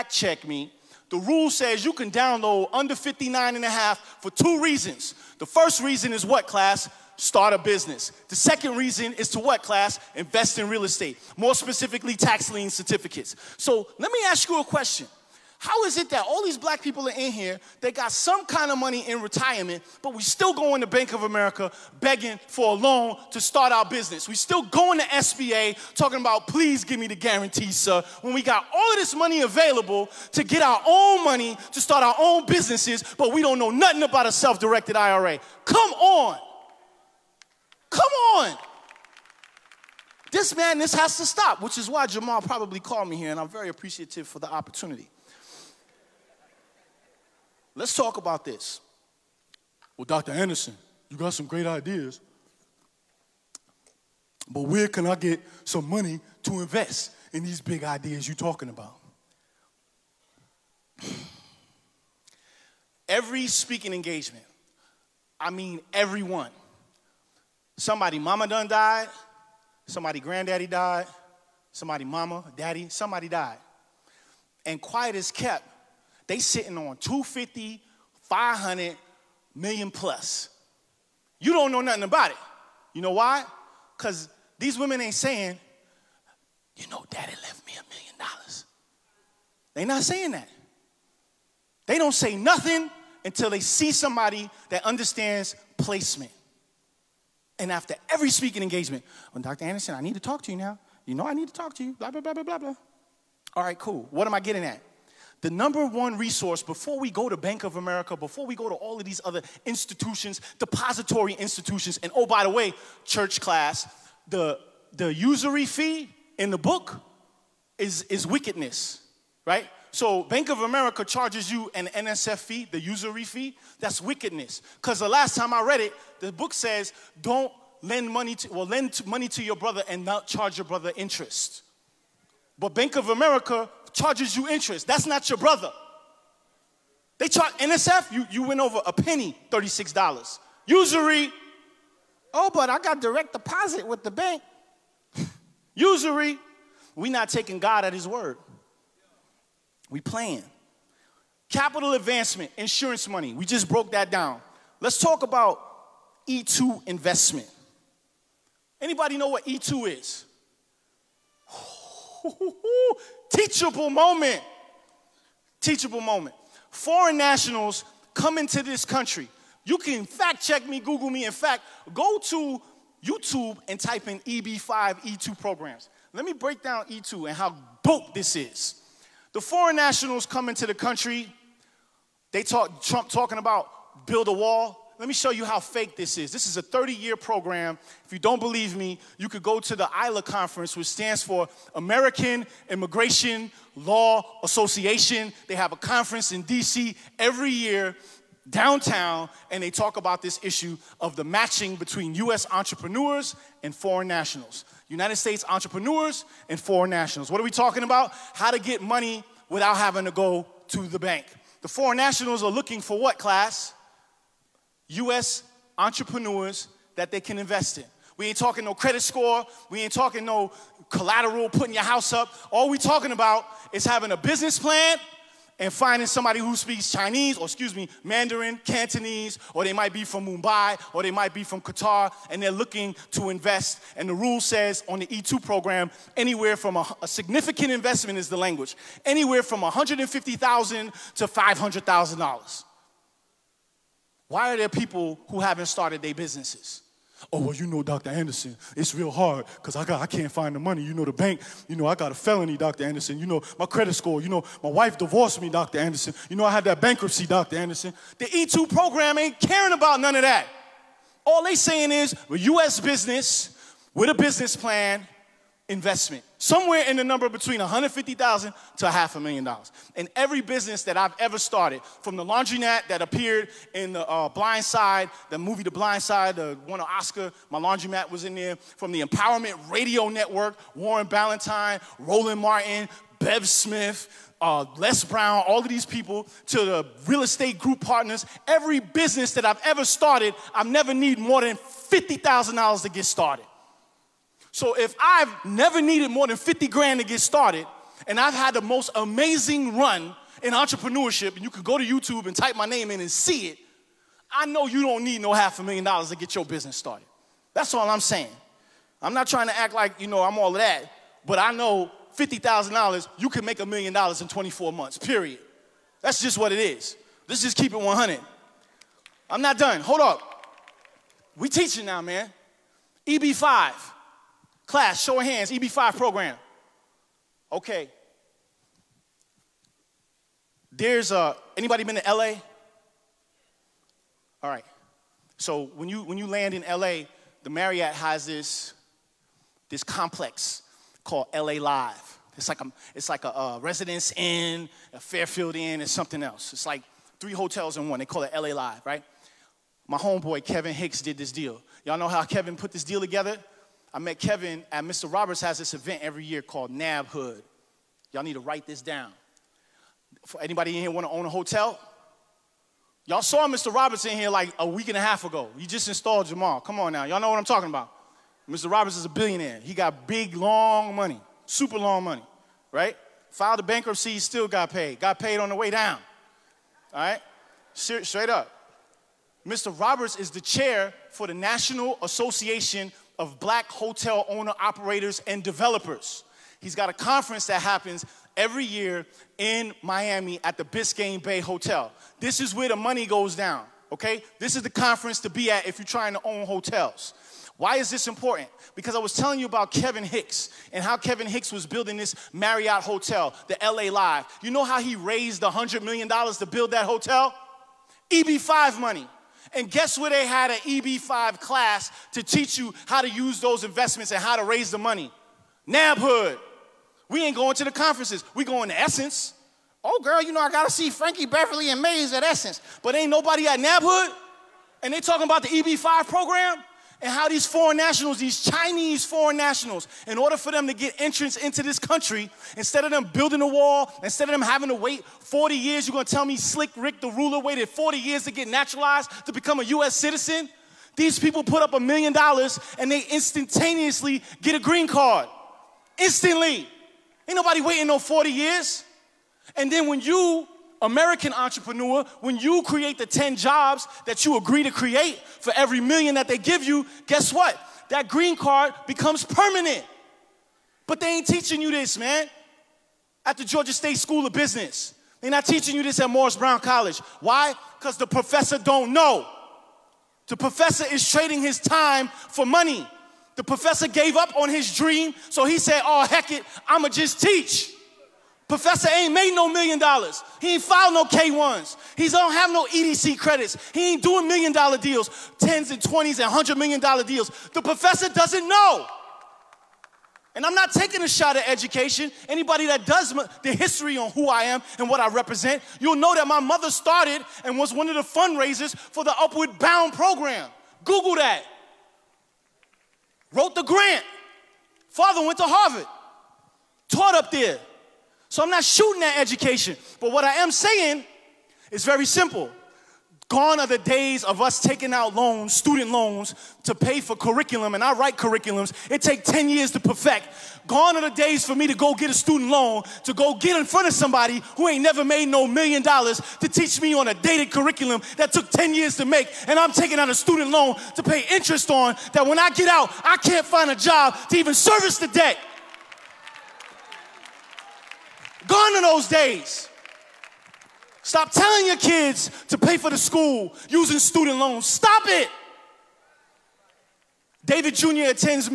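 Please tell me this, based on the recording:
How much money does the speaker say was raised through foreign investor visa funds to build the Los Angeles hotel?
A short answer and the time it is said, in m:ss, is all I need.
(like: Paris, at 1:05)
$100 million, at 6:45.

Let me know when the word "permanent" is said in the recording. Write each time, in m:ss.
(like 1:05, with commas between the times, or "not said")
7:39.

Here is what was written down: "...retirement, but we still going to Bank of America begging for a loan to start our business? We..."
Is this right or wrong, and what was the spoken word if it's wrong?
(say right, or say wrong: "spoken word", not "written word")
right.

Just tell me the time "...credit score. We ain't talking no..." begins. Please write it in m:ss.
3:38.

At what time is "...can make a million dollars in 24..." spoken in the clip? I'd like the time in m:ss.
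5:13.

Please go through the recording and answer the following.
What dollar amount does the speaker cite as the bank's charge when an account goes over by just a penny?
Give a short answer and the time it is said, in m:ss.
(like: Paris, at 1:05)
$36, at 2:19.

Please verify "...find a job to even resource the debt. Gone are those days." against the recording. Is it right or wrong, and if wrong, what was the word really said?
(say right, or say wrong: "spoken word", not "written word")
wrong: "service", not "resource".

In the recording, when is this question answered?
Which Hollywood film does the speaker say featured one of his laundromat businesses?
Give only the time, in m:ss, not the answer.
4:35.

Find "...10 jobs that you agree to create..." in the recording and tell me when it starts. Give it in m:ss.
7:33.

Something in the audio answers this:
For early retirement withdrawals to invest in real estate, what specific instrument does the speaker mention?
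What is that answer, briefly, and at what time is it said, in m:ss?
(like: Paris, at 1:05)
tax lien certificates, at 0:12.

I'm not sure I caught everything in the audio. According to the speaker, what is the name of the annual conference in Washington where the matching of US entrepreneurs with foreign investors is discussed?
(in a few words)
ILA conference.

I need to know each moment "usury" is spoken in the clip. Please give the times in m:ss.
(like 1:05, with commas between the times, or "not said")
1:55, 2:02, 2:20, 2:25.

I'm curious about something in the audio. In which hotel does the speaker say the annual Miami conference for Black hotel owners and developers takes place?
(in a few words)
Biscayne Bay Hotel.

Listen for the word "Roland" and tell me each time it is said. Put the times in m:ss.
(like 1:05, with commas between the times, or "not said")
4:42.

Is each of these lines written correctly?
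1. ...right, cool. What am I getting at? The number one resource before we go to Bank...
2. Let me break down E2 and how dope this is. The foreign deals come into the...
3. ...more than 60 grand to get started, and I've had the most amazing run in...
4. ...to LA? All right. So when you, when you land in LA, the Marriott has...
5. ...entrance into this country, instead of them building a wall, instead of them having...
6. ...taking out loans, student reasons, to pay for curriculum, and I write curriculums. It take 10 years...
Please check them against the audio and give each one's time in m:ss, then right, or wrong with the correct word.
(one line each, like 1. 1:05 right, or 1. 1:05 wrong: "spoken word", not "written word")
1. 1:43 right
2. 2:56 wrong: "nationals", not "deals"
3. 4:56 wrong: "50", not "60"
4. 5:31 right
5. 7:11 right
6. 8:34 wrong: "loans", not "reasons".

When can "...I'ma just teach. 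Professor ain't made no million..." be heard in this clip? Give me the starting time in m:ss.
7:56.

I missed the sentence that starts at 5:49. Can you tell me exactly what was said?
My homeboy Kevin Hicks did this deal.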